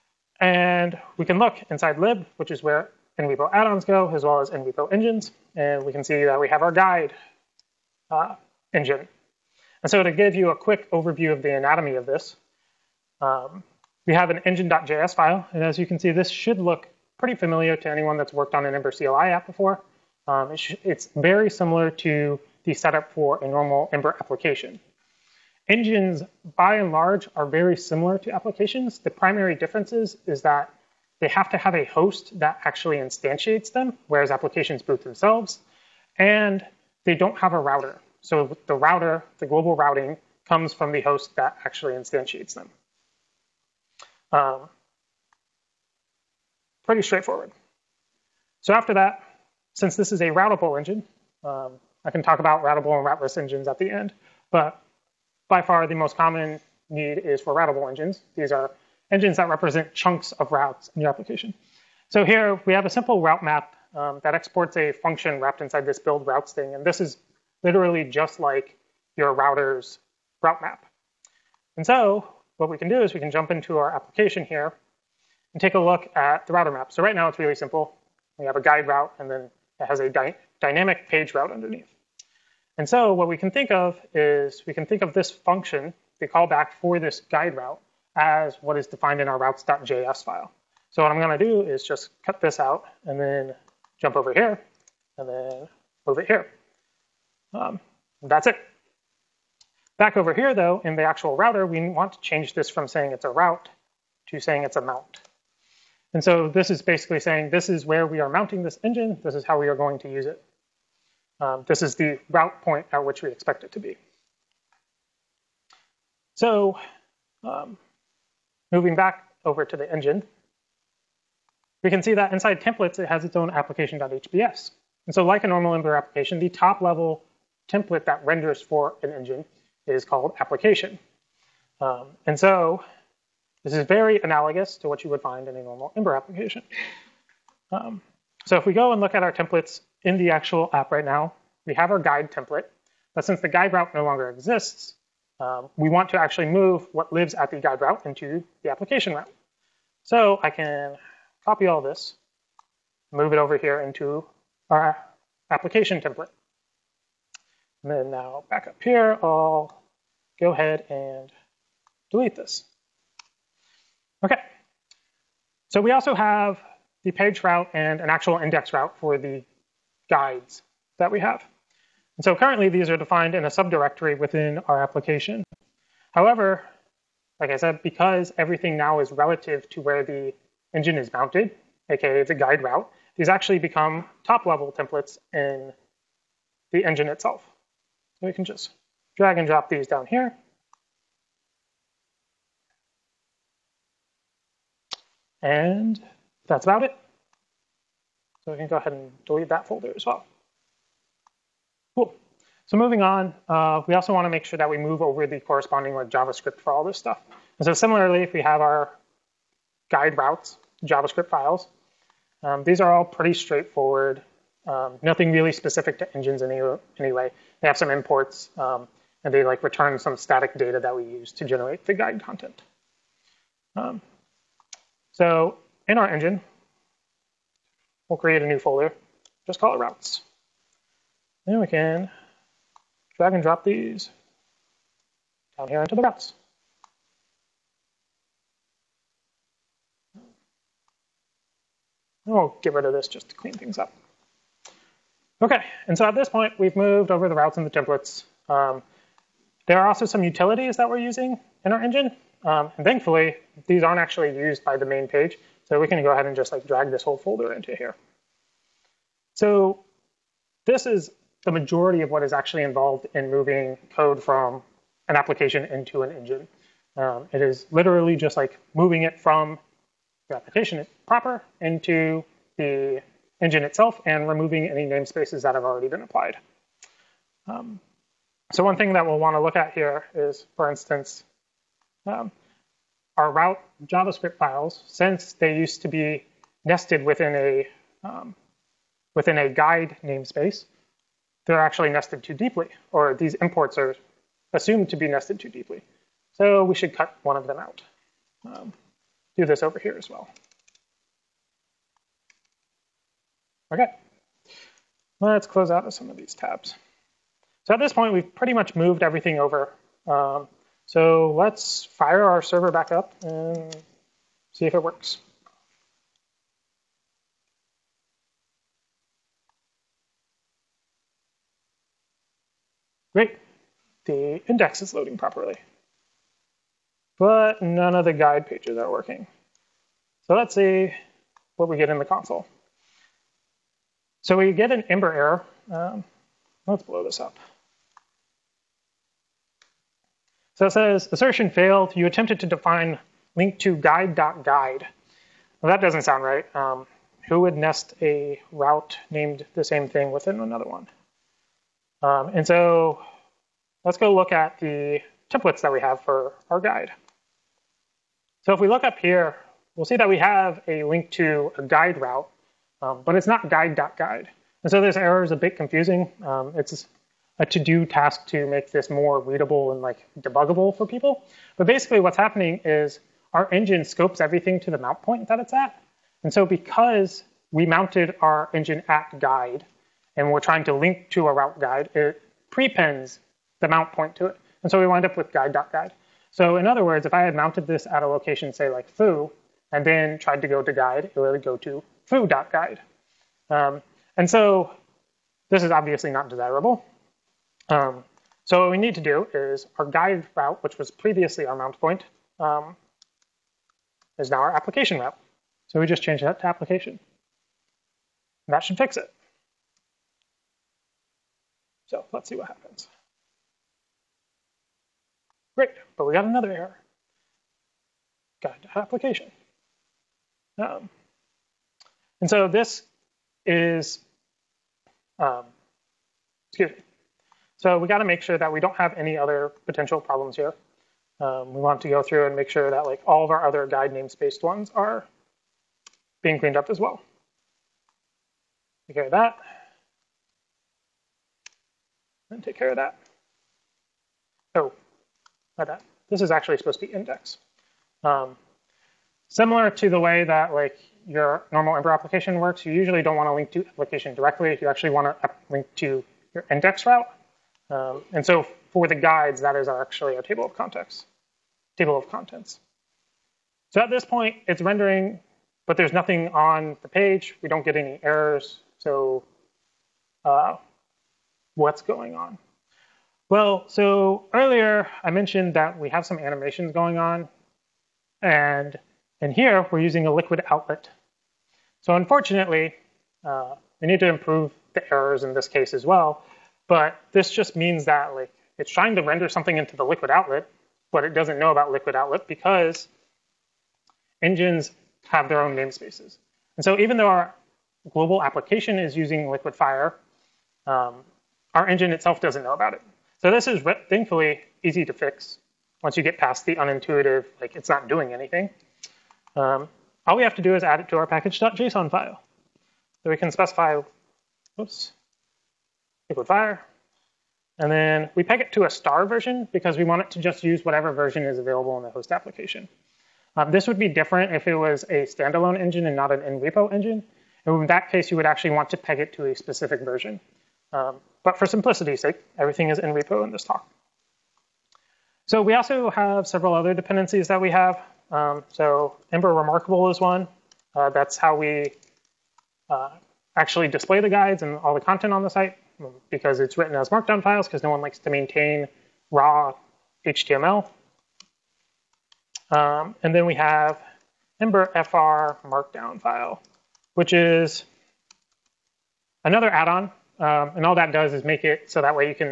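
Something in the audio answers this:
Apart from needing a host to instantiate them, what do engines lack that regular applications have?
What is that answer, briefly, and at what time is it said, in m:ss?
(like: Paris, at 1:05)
a router, at 0:37.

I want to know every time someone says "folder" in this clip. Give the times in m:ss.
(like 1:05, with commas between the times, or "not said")
3:19, 3:48, 4:17.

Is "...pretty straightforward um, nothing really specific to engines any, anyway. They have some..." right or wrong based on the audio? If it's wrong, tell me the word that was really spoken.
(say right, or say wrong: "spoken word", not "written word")
right.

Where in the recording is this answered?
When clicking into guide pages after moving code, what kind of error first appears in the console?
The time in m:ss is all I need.
5:34.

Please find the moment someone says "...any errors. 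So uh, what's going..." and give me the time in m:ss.
7:47.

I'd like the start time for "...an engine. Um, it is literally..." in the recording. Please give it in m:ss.
4:26.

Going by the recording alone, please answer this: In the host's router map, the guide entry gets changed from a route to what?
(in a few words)
a mount.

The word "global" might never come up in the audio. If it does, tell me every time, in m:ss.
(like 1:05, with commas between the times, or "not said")
0:39, 8:17.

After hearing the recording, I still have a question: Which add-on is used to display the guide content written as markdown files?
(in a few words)
Ember Remarkable.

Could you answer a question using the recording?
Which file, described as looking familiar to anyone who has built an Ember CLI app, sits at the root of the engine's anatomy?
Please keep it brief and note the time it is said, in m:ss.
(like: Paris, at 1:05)
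engine.js, at 0:14.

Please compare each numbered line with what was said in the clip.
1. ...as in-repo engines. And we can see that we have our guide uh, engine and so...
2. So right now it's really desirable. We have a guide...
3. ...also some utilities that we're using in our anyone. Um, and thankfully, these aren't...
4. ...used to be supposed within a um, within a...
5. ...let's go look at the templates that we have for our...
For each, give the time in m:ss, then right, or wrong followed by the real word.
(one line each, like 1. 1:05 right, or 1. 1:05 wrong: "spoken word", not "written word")
1. 0:04 right
2. 1:16 wrong: "simple", not "desirable"
3. 4:09 wrong: "engine", not "anyone"
4. 4:45 wrong: "nested", not "supposed"
5. 5:53 right.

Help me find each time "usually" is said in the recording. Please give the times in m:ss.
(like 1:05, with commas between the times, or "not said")
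7:32.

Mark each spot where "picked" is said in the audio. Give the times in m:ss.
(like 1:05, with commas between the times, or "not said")
not said.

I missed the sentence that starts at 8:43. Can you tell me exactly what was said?
Um, this would be different if it was a standalone engine and not an in-repo engine.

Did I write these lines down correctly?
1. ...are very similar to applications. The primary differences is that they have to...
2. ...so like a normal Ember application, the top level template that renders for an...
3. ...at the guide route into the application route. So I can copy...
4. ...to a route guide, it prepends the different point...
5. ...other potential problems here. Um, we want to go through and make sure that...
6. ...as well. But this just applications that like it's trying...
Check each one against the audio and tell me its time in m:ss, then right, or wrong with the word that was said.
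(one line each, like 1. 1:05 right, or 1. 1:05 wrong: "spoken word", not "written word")
1. 0:27 right
2. 2:05 right
3. 2:27 right
4. 6:21 wrong: "mount", not "different"
5. 7:09 right
6. 8:05 wrong: "means", not "applications".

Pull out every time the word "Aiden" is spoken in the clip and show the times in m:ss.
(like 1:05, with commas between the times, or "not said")
not said.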